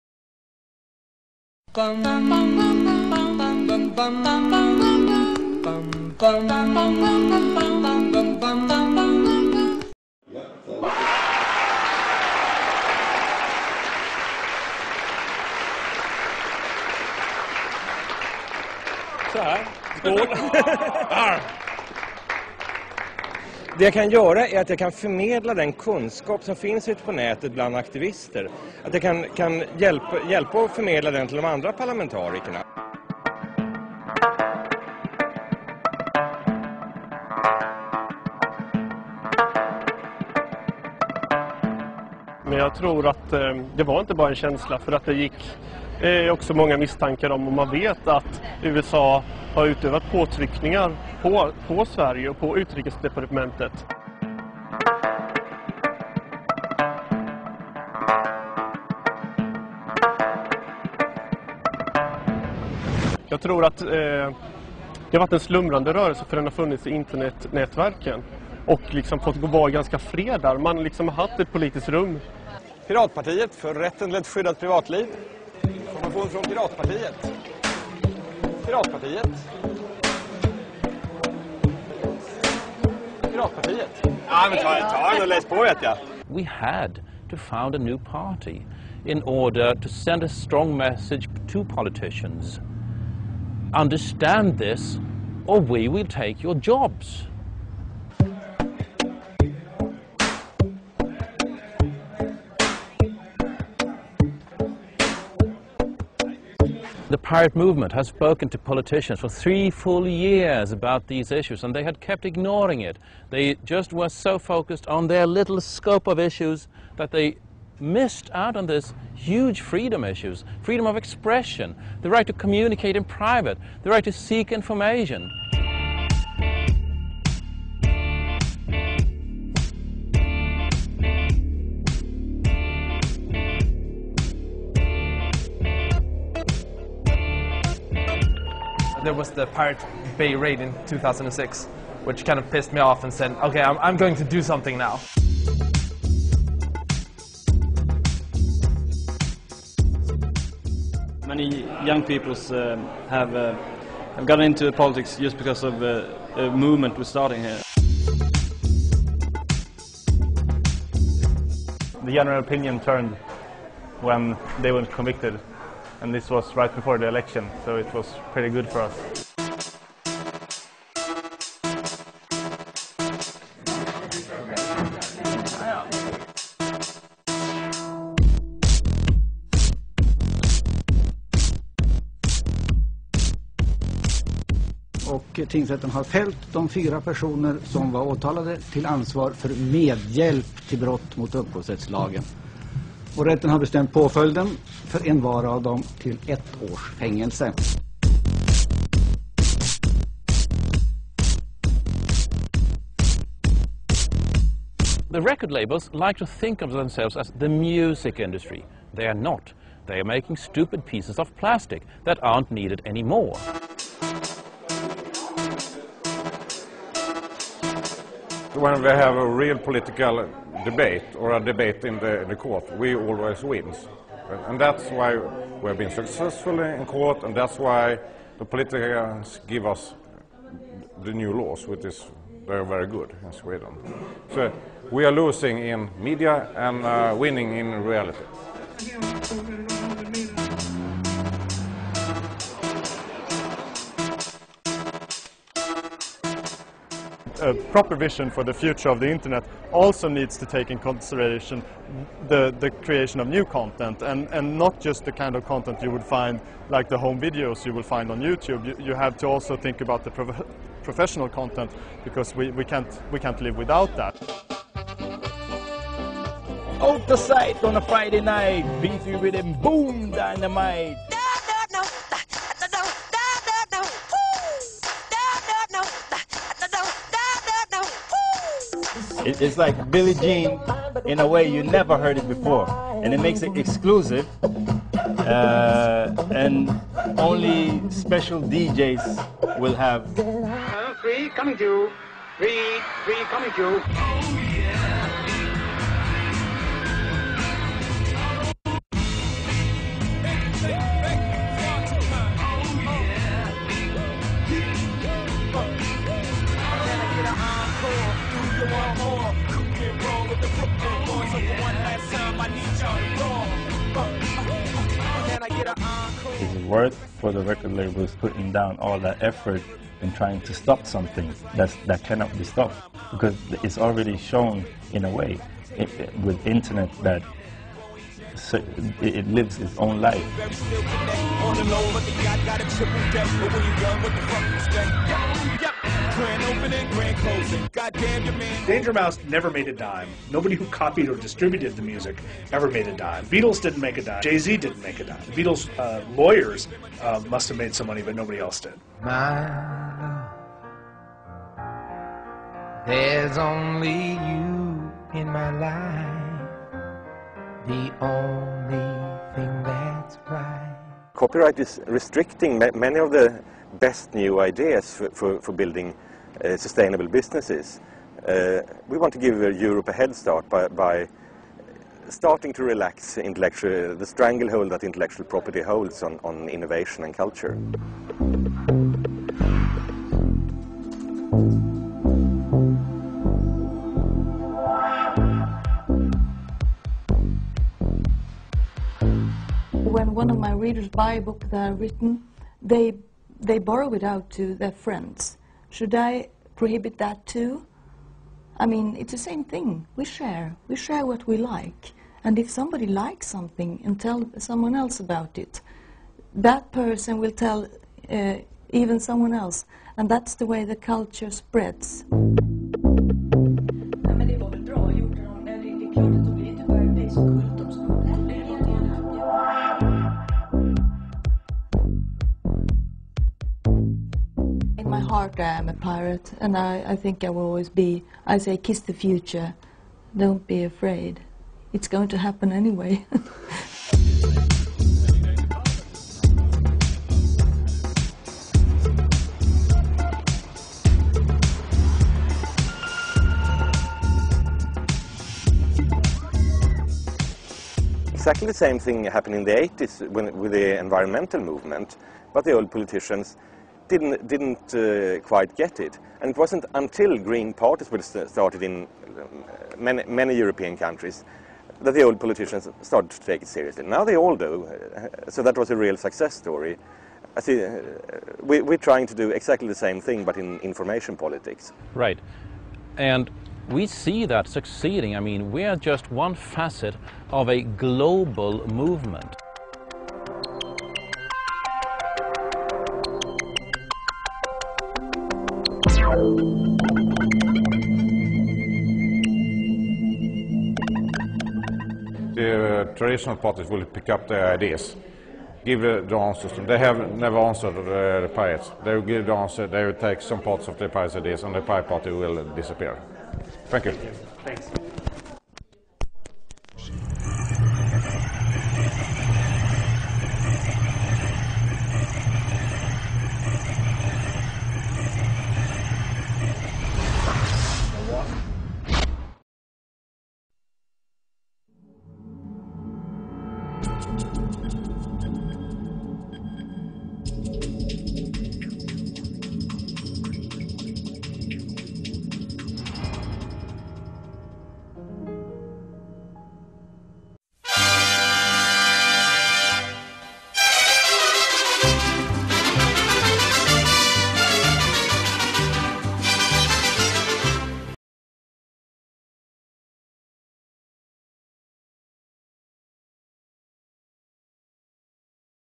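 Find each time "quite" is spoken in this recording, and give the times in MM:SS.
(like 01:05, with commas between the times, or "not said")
07:35.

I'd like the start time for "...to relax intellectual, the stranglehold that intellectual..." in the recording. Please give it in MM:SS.
06:12.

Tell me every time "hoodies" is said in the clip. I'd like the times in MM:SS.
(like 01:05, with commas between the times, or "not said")
not said.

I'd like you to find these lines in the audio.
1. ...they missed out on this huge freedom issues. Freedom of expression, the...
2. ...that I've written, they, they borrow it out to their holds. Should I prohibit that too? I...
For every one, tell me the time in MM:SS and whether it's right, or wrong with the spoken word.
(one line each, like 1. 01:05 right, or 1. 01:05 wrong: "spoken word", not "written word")
1. 01:57 right
2. 06:31 wrong: "friends", not "holds".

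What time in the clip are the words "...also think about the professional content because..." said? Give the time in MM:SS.
04:19.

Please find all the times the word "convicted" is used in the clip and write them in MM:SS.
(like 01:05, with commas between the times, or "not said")
02:44.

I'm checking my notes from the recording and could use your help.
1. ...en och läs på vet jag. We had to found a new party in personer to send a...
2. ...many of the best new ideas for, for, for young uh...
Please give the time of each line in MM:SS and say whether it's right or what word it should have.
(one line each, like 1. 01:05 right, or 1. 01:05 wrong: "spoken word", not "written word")
1. 01:25 wrong: "order", not "personer"
2. 06:02 wrong: "building", not "young".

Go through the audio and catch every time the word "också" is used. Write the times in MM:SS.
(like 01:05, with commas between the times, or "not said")
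00:46.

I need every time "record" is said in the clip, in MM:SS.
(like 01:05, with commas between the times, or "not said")
03:25, 05:17.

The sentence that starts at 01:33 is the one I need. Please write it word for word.
Understand this or we will take your jobs.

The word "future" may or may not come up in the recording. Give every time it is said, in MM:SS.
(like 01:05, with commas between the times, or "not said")
04:08, 07:08.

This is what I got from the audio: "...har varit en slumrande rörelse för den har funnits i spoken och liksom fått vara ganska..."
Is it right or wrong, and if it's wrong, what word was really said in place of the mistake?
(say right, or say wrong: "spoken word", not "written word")
wrong: "internetnätverken", not "spoken".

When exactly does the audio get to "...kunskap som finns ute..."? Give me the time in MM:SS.
00:25.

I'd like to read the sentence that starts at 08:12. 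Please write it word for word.
The uh, traditional parties will pick up their ideas, give the answers.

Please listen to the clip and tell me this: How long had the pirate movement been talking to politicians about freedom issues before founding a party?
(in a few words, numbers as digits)
3 years.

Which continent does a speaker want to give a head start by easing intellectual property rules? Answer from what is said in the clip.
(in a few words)
Europe.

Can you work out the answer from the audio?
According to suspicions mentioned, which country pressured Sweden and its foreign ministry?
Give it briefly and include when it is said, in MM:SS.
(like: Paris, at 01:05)
USA, at 00:48.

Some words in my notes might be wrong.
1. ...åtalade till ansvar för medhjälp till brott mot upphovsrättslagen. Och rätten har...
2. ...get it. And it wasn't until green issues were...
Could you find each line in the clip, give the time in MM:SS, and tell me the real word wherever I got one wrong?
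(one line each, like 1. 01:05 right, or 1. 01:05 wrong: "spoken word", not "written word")
1. 03:08 right
2. 07:35 wrong: "parties", not "issues".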